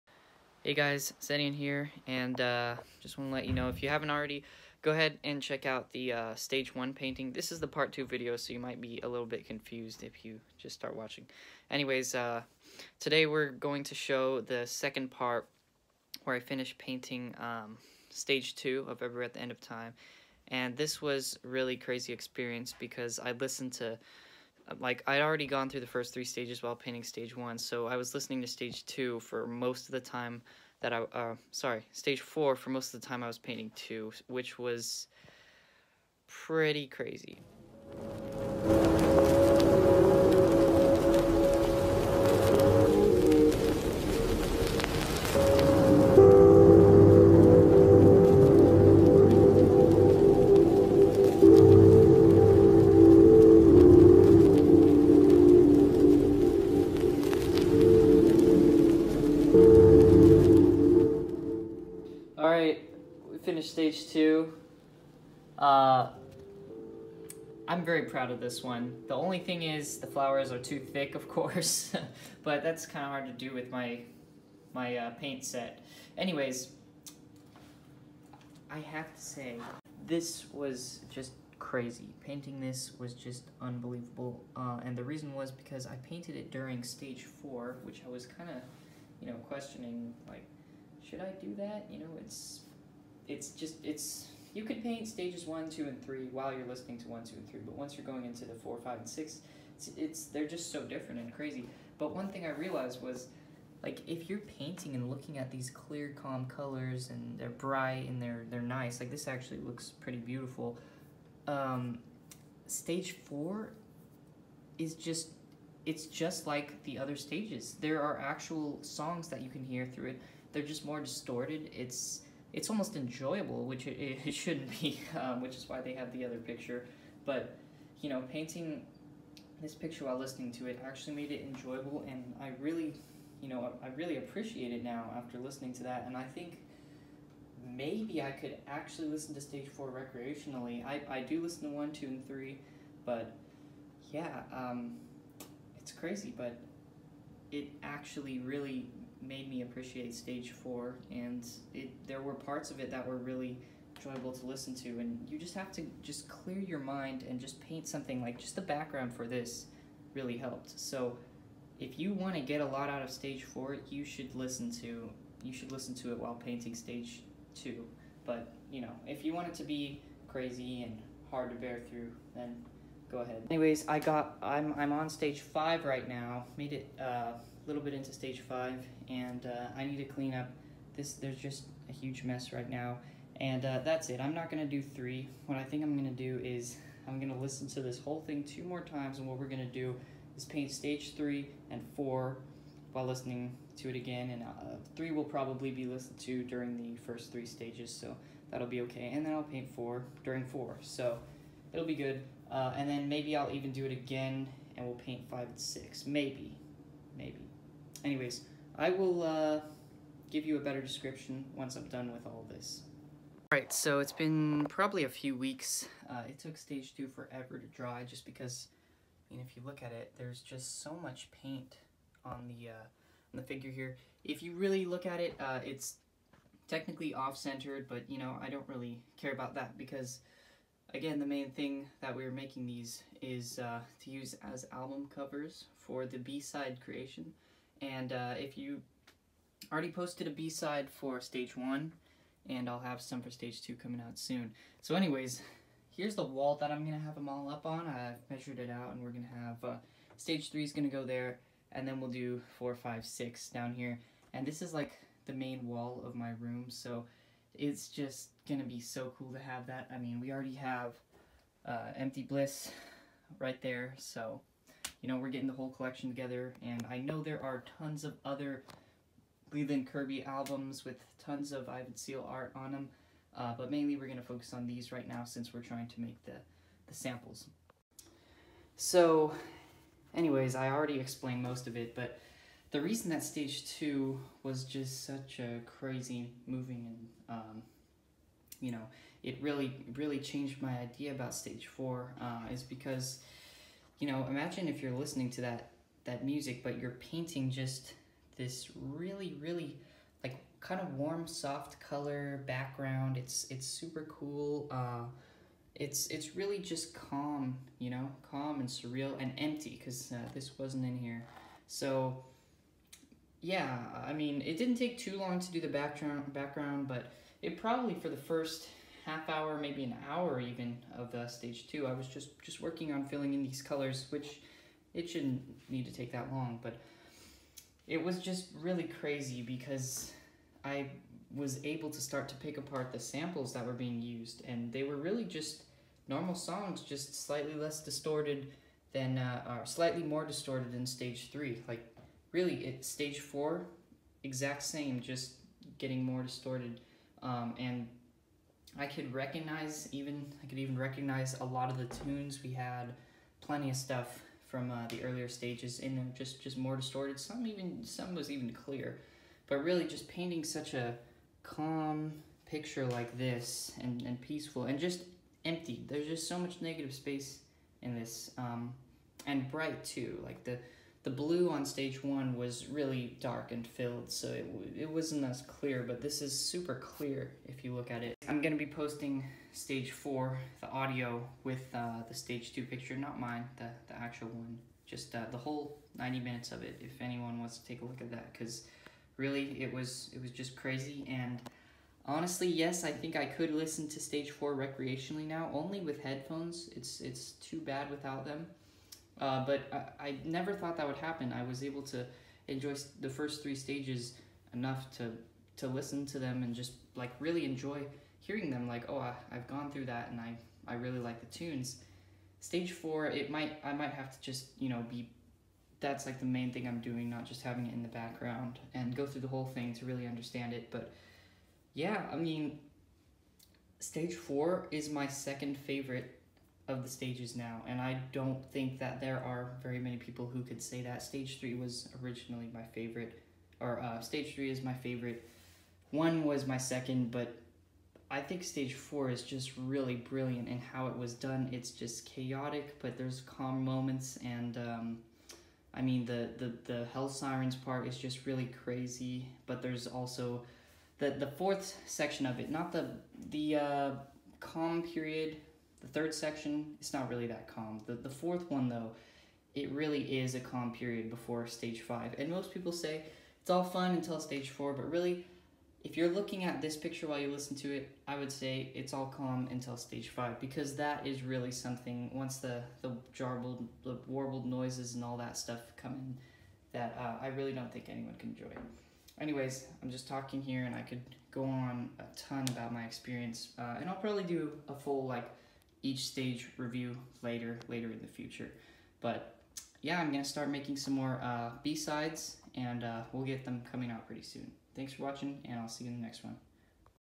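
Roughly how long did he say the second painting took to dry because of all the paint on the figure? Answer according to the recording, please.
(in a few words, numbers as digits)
A few weeks.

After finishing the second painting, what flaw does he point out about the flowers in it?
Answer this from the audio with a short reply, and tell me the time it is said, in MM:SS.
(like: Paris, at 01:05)
Too thick, at 01:10.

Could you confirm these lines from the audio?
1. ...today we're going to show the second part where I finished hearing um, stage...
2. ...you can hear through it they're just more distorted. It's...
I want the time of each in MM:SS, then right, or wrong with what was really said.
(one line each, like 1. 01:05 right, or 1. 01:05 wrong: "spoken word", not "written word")
1. 00:12 wrong: "painting", not "hearing"
2. 01:59 right.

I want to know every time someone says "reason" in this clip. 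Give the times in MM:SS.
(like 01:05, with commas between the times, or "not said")
01:25, 04:42.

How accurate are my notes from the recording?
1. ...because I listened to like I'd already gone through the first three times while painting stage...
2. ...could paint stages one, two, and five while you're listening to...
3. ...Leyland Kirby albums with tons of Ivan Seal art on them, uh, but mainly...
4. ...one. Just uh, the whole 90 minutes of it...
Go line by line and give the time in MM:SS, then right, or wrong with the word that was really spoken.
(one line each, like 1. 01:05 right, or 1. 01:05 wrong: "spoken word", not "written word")
1. 00:22 wrong: "stages", not "times"
2. 01:34 wrong: "three", not "five"
3. 04:29 right
4. 06:24 right.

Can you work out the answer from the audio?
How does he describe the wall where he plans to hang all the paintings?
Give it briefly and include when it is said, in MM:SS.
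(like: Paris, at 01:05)
The main wall, at 04:15.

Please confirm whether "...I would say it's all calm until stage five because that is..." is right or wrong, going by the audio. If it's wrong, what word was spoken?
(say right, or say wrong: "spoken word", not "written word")
right.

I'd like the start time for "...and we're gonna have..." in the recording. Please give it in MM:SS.
04:08.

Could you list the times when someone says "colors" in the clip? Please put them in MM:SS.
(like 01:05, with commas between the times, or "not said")
01:46, 05:01, 05:23.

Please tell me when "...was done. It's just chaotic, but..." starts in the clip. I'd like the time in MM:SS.
07:20.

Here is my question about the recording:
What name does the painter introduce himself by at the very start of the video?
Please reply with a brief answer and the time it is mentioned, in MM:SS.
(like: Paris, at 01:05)
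Zedian, at 00:01.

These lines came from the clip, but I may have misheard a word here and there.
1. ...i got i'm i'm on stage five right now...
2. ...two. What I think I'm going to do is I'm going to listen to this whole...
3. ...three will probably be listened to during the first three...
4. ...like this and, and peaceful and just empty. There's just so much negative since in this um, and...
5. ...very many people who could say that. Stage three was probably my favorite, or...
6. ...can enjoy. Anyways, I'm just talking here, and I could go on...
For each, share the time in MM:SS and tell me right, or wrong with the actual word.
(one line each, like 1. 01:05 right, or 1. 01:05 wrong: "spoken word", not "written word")
1. 02:53 right
2. 03:04 wrong: "three", not "two"
3. 03:14 right
4. 06:02 wrong: "space", not "since"
5. 07:09 wrong: "originally", not "probably"
6. 07:58 right.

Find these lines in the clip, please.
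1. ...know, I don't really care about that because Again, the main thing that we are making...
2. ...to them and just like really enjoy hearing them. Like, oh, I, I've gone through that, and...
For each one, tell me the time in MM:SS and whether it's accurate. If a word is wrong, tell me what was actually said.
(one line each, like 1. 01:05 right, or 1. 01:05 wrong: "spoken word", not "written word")
1. 03:48 right
2. 06:46 right.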